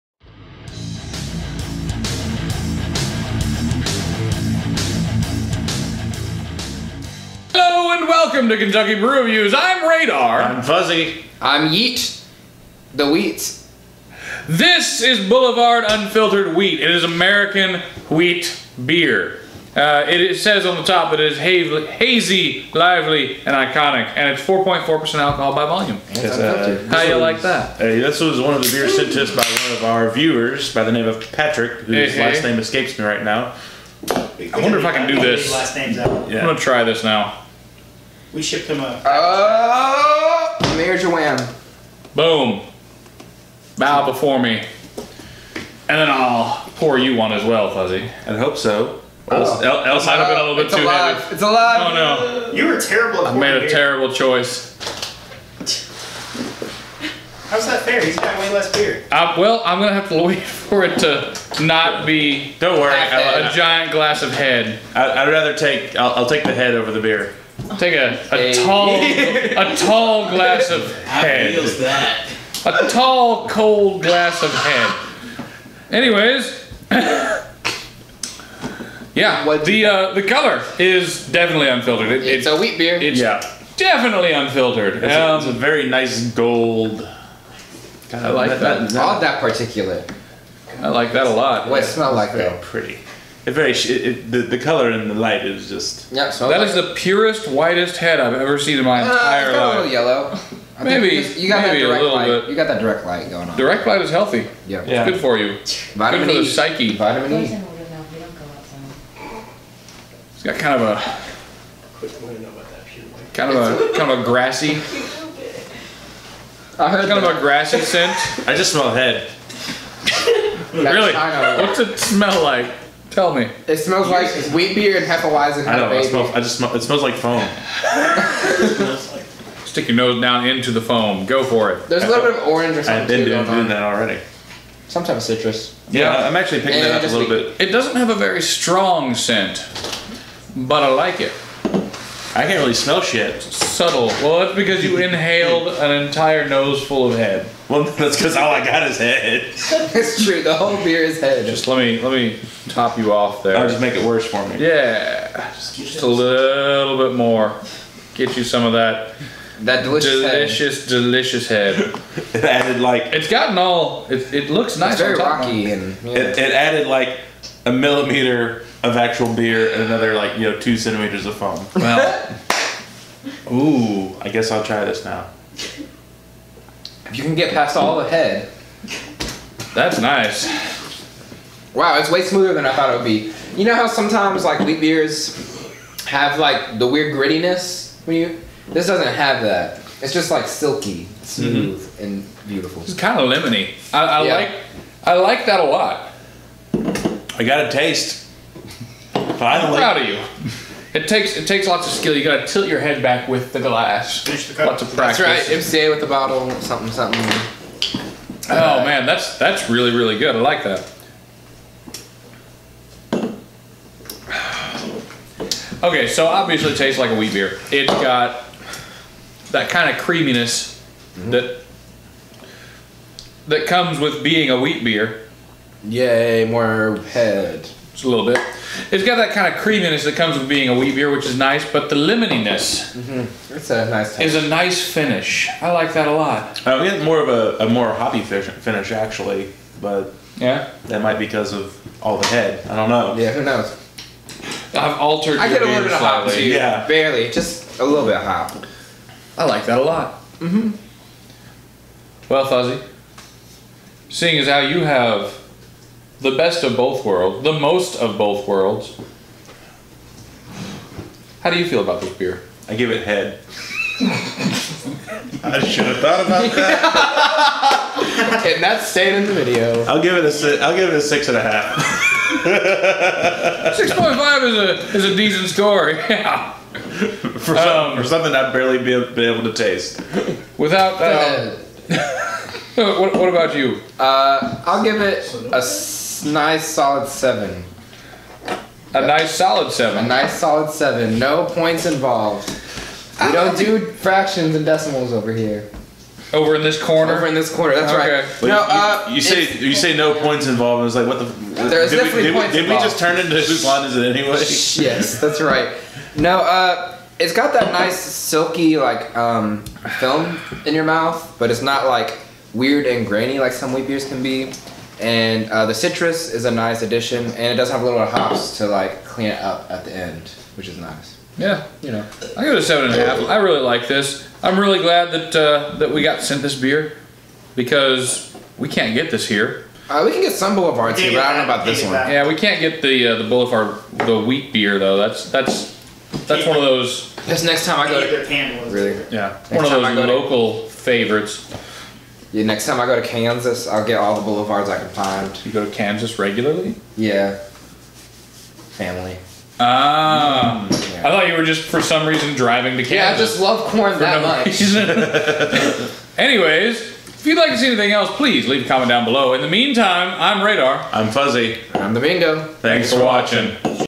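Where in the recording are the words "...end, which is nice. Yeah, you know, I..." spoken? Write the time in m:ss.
5:19.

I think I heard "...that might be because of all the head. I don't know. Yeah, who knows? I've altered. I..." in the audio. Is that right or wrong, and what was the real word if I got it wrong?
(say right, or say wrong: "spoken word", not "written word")
right.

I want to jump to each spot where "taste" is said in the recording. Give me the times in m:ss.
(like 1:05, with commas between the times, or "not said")
3:17, 3:36, 4:39.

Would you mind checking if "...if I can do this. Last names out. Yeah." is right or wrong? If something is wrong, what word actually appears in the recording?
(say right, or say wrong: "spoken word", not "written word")
right.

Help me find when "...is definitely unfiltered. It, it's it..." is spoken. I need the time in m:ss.
1:20.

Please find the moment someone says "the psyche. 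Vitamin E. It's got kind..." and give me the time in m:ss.
1:46.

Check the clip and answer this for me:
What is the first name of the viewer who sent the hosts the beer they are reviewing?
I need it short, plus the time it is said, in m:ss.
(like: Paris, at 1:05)
Patrick, at 0:31.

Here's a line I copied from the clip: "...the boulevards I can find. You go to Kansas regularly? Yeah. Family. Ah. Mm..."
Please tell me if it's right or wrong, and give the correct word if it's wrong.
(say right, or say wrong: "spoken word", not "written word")
right.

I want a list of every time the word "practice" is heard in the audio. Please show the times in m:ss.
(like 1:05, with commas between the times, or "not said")
3:24.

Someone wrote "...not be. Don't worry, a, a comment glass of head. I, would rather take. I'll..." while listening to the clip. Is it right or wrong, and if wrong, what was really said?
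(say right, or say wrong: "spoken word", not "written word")
wrong: "giant", not "comment".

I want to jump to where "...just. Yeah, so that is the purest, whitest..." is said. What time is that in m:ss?
1:35.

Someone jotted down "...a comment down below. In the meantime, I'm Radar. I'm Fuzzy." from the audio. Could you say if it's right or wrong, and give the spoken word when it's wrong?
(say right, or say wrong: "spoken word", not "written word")
right.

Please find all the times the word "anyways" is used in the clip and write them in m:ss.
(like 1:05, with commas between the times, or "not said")
1:15, 5:04, 5:56.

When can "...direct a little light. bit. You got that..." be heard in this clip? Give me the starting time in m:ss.
1:41.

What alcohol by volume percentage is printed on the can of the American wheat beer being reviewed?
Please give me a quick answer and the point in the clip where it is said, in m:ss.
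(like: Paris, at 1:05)
4.4%, at 0:24.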